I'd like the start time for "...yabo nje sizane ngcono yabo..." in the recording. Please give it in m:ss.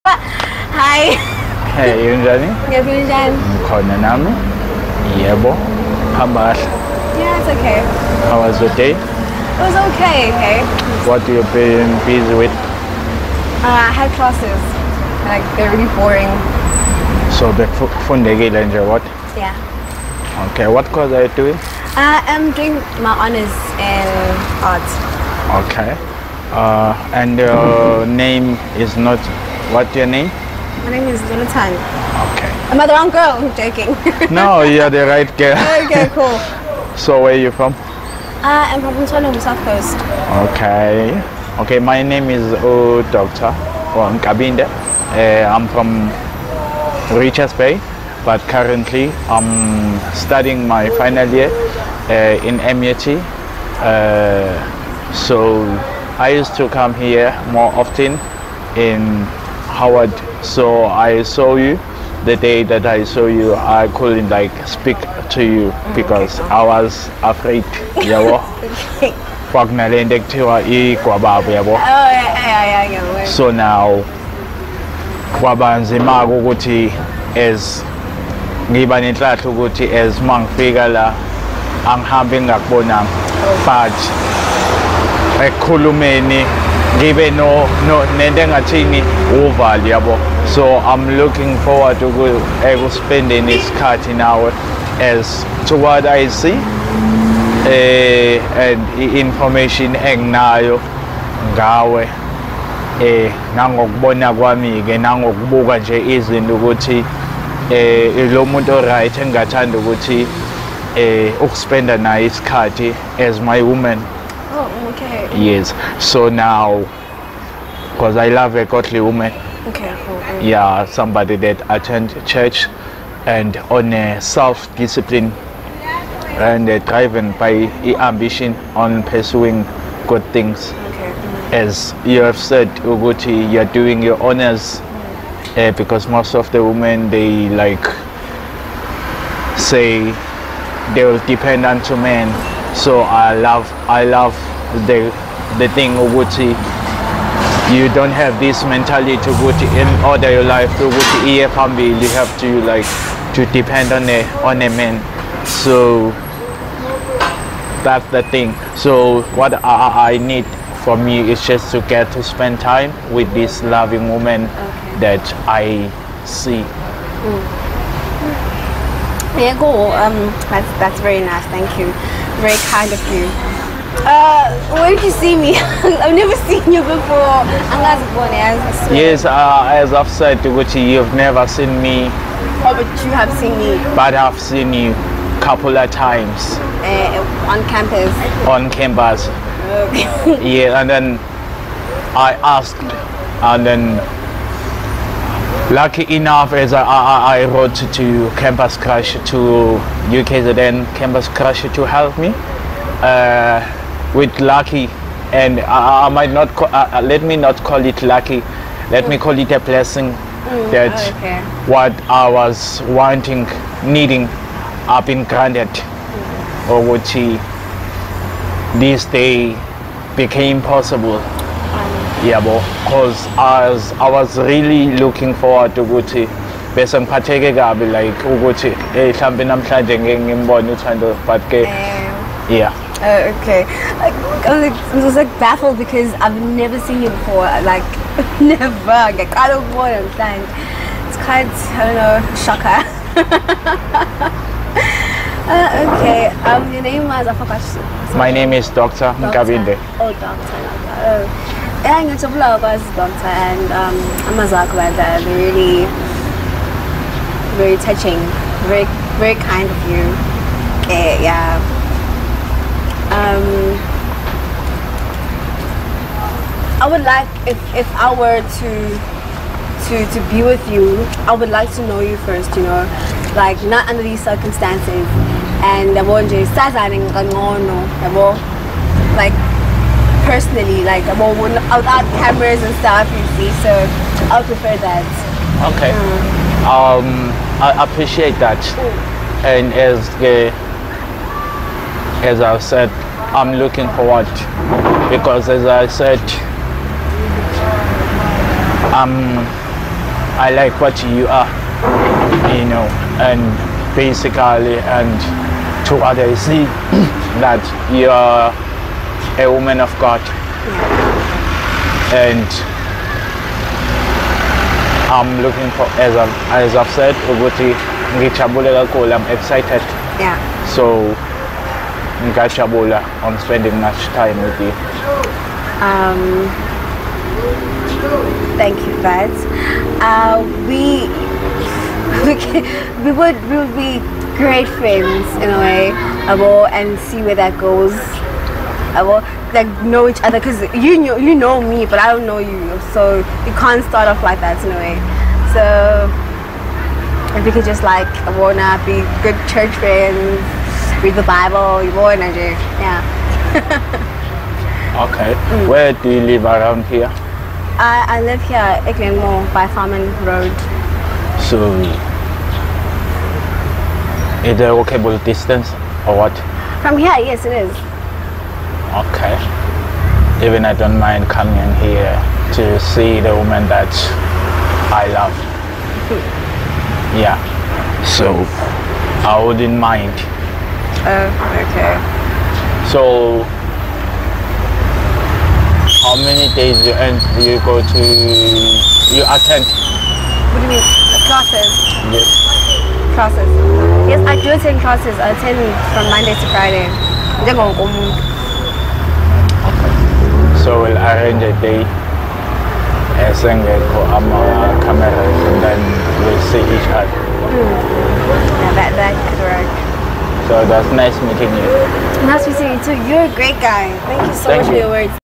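4:35.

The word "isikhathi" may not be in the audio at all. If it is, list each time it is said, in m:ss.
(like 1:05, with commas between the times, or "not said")
1:33, 1:52.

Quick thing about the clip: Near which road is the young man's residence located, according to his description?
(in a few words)
Farman Road.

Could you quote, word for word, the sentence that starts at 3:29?
me call it a blessing mm, that oh, okay.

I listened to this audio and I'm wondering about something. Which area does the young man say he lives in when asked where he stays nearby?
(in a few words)
Glenmore.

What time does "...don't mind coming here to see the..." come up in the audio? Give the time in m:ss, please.
6:10.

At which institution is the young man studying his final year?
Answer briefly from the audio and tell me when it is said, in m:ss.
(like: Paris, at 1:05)
MUT, at 0:52.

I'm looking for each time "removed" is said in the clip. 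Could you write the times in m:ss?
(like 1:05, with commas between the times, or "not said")
not said.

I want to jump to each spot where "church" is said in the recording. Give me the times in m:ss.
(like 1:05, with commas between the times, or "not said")
2:02, 5:49.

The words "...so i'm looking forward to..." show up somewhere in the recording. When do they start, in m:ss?
1:30.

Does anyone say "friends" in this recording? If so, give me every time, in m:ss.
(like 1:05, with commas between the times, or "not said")
5:34, 5:49.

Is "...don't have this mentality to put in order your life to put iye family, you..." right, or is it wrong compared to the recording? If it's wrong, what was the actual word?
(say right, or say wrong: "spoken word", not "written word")
right.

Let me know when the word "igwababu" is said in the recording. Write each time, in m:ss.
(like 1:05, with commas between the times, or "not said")
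1:10.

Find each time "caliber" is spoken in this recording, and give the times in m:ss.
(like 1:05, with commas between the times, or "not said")
not said.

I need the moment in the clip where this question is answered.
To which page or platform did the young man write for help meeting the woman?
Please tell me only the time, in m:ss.
3:20.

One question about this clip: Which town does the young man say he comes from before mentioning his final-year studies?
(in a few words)
Richards Bay.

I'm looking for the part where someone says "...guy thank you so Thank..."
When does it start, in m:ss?
6:53.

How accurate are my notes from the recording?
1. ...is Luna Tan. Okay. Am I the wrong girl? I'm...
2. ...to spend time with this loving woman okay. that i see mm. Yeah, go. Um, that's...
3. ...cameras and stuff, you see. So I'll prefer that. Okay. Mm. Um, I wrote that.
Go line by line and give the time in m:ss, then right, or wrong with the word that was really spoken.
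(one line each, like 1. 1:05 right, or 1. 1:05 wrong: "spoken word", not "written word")
1. 0:31 right
2. 2:42 right
3. 4:42 wrong: "appreciate", not "wrote".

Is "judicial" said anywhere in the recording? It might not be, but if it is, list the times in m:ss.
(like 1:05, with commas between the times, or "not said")
not said.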